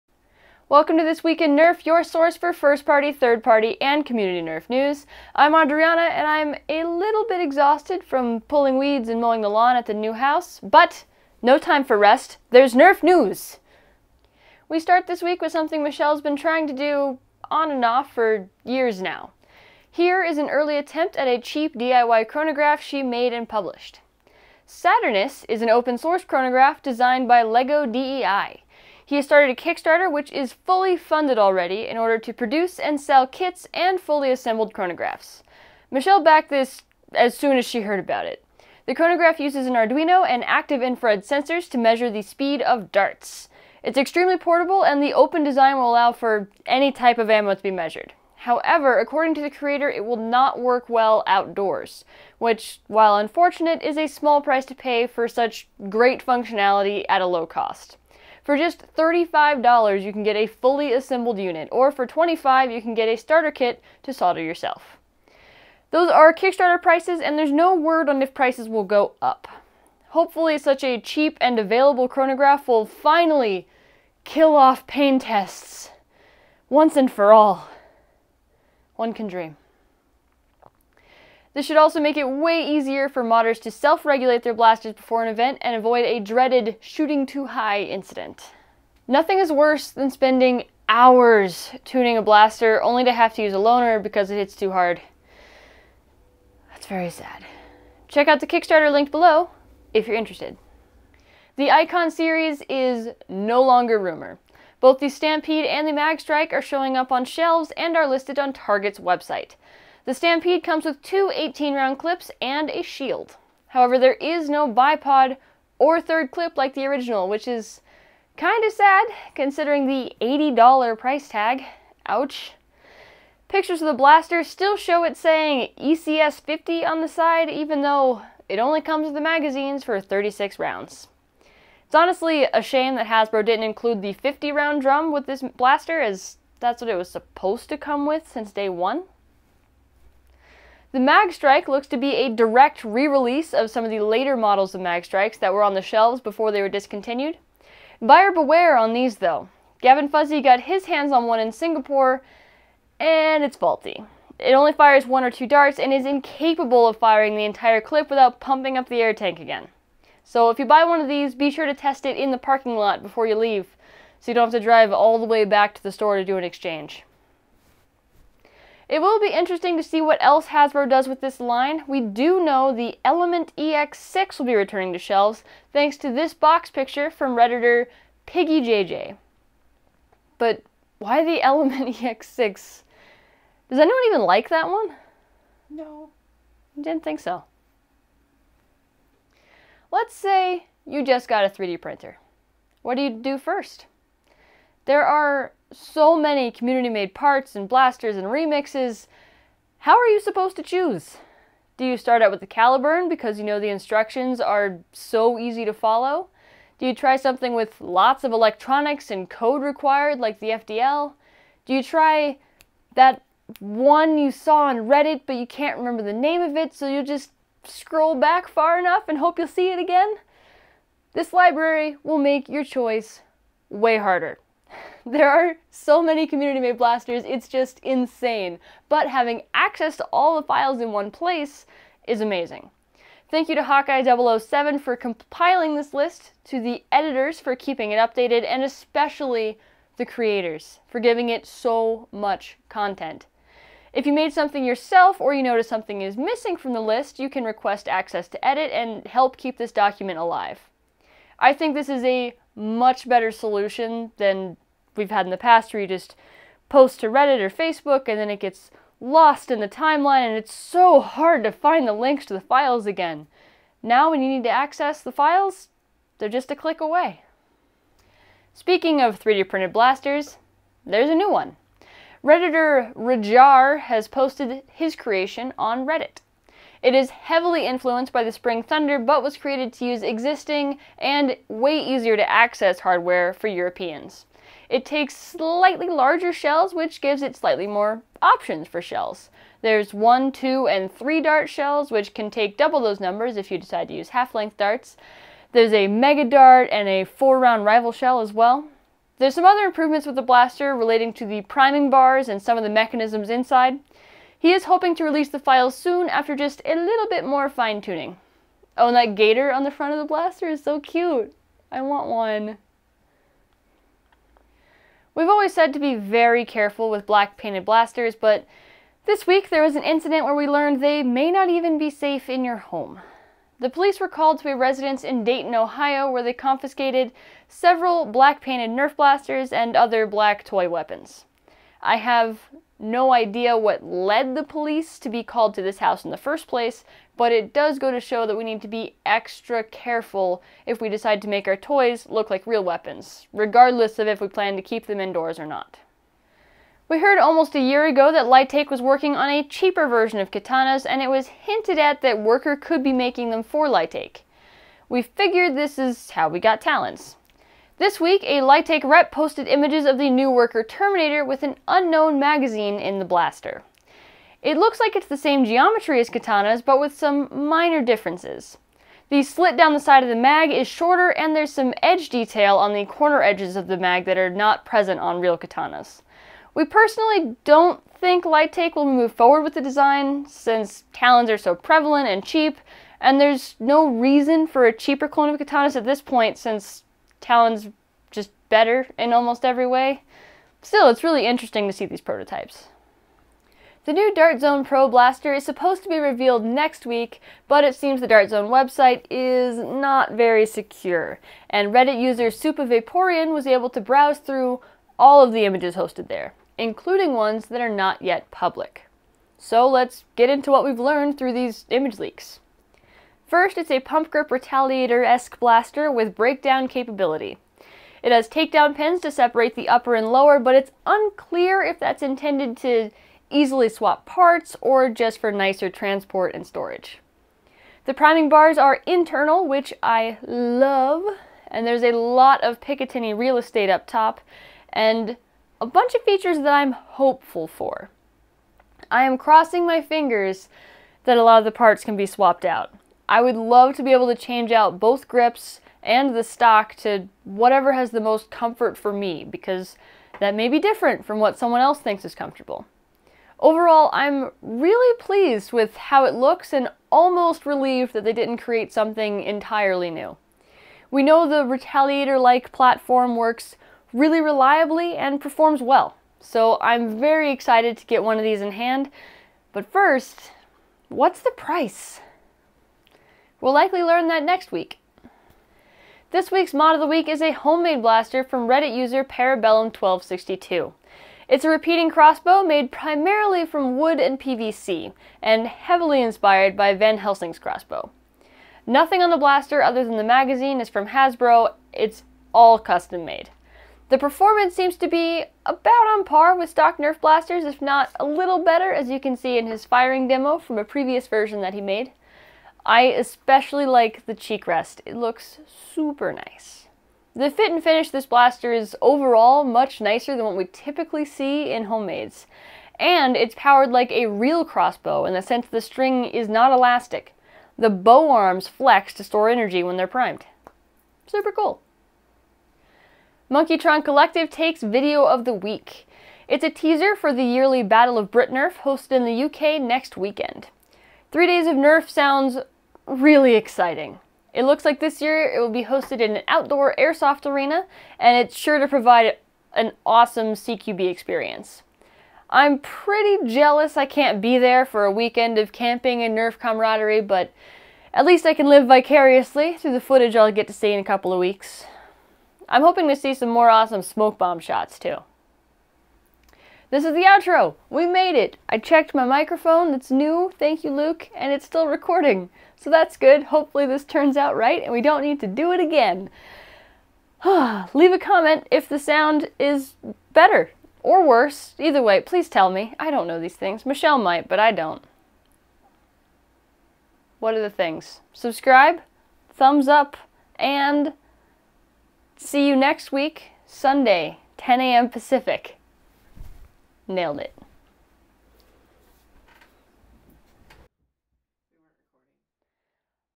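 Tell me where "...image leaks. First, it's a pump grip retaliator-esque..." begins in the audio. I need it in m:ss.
6:51.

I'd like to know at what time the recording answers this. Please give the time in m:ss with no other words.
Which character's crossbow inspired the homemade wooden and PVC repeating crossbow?
8:06.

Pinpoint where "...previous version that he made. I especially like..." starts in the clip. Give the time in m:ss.
8:20.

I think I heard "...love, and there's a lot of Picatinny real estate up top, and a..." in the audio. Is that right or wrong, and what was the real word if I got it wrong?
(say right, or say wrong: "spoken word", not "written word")
right.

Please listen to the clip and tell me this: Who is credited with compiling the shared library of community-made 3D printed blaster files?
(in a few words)
Hawkeye007.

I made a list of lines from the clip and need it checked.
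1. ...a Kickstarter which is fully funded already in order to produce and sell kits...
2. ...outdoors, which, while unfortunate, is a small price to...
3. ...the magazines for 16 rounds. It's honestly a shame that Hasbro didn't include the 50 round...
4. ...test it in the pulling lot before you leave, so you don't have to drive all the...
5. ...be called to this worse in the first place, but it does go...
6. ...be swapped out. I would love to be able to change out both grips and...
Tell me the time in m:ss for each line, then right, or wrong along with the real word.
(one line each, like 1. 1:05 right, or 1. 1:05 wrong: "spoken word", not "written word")
1. 0:29 right
2. 0:51 right
3. 2:09 wrong: "36", not "16"
4. 2:41 wrong: "parking", not "pulling"
5. 5:35 wrong: "house", not "worse"
6. 7:21 right.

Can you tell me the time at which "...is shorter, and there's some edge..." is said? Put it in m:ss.
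6:10.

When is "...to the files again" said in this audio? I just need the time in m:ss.
4:22.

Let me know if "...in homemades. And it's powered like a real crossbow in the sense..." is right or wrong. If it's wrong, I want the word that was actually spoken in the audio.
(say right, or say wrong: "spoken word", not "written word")
right.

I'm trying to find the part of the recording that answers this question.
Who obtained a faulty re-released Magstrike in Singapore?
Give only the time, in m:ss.
2:29.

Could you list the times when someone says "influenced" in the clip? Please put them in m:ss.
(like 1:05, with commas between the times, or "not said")
4:37.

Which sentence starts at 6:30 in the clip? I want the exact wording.
Still, it's really interesting to see these prototypes.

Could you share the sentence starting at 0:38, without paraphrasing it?
The chronograph uses an Arduino and active infrared sensors to measure the speed of darts.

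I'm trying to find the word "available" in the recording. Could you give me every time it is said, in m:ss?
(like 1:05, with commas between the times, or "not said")
1:11.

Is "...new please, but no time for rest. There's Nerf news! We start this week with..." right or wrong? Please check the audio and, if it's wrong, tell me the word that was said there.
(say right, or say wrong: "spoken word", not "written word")
wrong: "house", not "please".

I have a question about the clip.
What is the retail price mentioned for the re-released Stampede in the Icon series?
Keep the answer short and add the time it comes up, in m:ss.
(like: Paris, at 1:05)
$80, at 2:00.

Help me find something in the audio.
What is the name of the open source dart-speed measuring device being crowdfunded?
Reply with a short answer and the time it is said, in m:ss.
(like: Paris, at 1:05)
Saturnus, at 0:24.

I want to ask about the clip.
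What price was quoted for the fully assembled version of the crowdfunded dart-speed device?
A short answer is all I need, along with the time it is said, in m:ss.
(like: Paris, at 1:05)
$35, at 0:58.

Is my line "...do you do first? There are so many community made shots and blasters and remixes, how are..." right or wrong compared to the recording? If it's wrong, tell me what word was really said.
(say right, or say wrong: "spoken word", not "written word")
wrong: "parts", not "shots".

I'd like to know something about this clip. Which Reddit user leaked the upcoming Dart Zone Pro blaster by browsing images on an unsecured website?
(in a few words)
Supavaporian.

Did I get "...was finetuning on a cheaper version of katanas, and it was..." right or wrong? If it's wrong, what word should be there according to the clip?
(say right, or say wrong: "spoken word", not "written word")
wrong: "working", not "finetuning".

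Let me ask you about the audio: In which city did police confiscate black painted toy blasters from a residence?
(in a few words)
Dayton, Ohio.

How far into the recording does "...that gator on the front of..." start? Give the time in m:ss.
5:08.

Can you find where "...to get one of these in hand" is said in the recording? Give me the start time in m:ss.
7:47.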